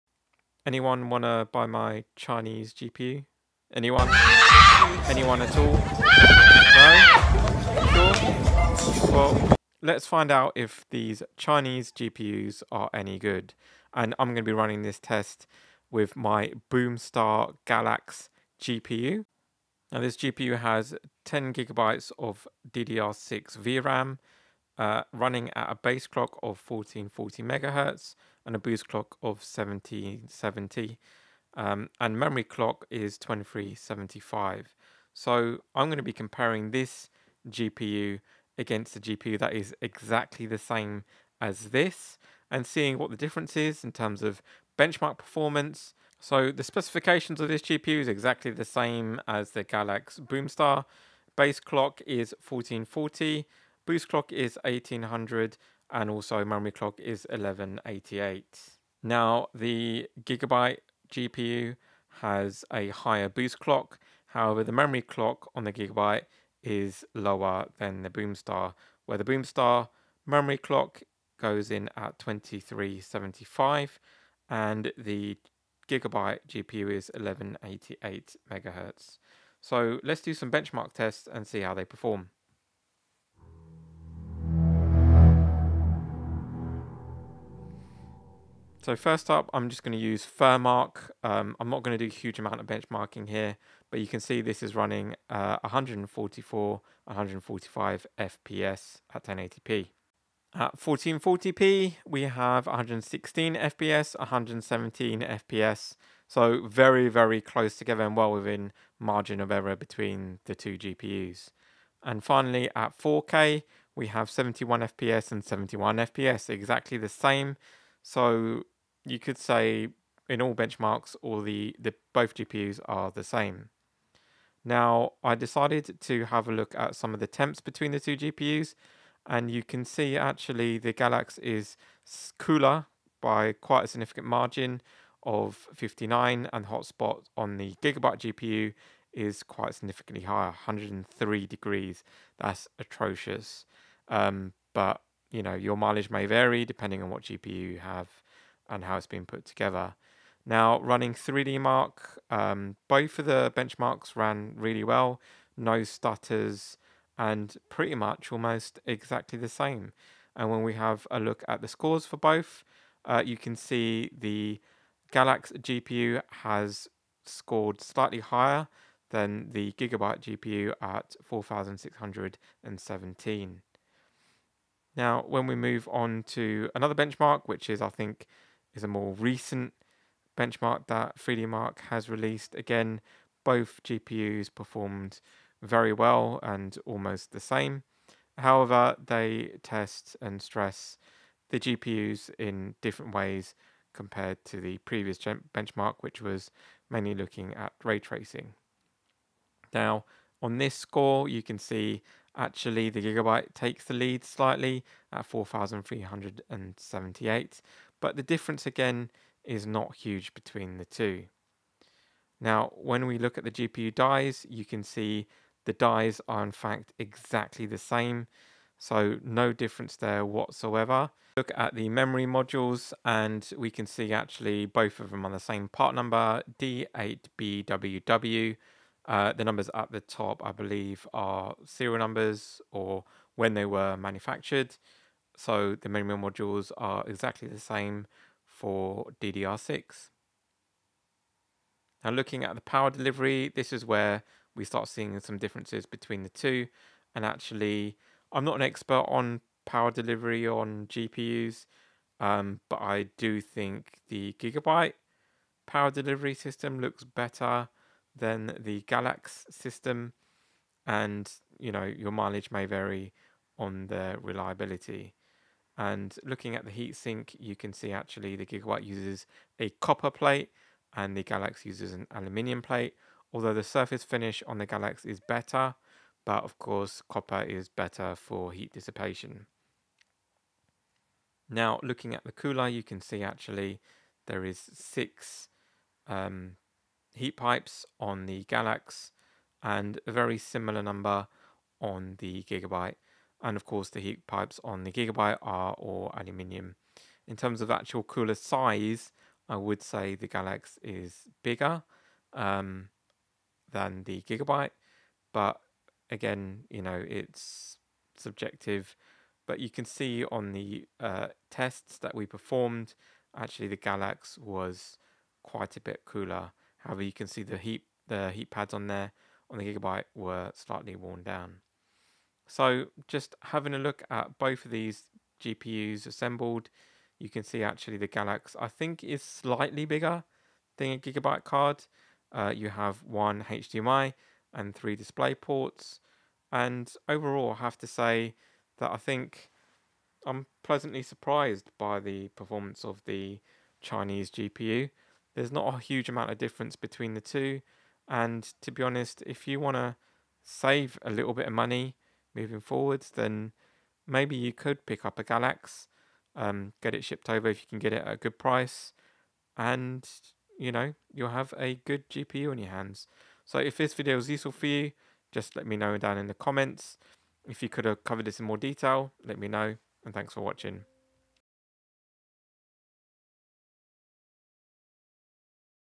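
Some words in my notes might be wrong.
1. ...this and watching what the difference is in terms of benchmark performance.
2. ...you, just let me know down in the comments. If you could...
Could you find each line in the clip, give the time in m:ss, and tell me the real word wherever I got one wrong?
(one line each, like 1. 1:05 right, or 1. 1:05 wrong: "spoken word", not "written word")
1. 0:41 wrong: "seeing", not "watching"
2. 6:04 right.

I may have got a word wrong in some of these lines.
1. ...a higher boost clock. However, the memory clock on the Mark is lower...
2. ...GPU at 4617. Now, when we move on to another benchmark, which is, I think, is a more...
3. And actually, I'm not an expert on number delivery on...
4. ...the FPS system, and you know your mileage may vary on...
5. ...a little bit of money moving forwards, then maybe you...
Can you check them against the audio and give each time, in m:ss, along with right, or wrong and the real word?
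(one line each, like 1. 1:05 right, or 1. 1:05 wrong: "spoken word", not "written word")
1. 1:02 wrong: "Gigabyte", not "Mark"
2. 2:50 right
3. 4:07 wrong: "power", not "number"
4. 4:18 wrong: "Galax", not "FPS"
5. 5:51 right.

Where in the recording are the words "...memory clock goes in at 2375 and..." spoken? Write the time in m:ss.
1:10.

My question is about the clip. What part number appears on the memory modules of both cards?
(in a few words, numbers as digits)
D8BWW.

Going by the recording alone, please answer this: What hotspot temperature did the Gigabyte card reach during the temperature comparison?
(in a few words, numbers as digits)
103 degrees.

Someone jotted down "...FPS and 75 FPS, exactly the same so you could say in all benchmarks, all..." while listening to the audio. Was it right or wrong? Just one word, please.
wrong.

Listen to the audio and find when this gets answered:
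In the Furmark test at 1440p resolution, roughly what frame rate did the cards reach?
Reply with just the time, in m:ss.
1:42.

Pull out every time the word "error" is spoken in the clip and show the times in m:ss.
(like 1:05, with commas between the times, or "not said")
1:49.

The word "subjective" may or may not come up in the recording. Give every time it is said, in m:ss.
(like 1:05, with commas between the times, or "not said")
5:08.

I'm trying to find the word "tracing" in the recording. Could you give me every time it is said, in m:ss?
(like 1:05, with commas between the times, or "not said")
3:17.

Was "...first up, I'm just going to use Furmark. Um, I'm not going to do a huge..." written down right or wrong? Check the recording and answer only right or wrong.
right.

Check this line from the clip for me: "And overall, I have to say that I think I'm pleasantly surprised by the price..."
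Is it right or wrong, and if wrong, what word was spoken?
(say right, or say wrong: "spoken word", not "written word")
wrong: "performance", not "price".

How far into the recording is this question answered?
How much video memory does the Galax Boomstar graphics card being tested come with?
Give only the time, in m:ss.
0:21.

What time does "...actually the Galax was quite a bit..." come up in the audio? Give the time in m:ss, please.
5:13.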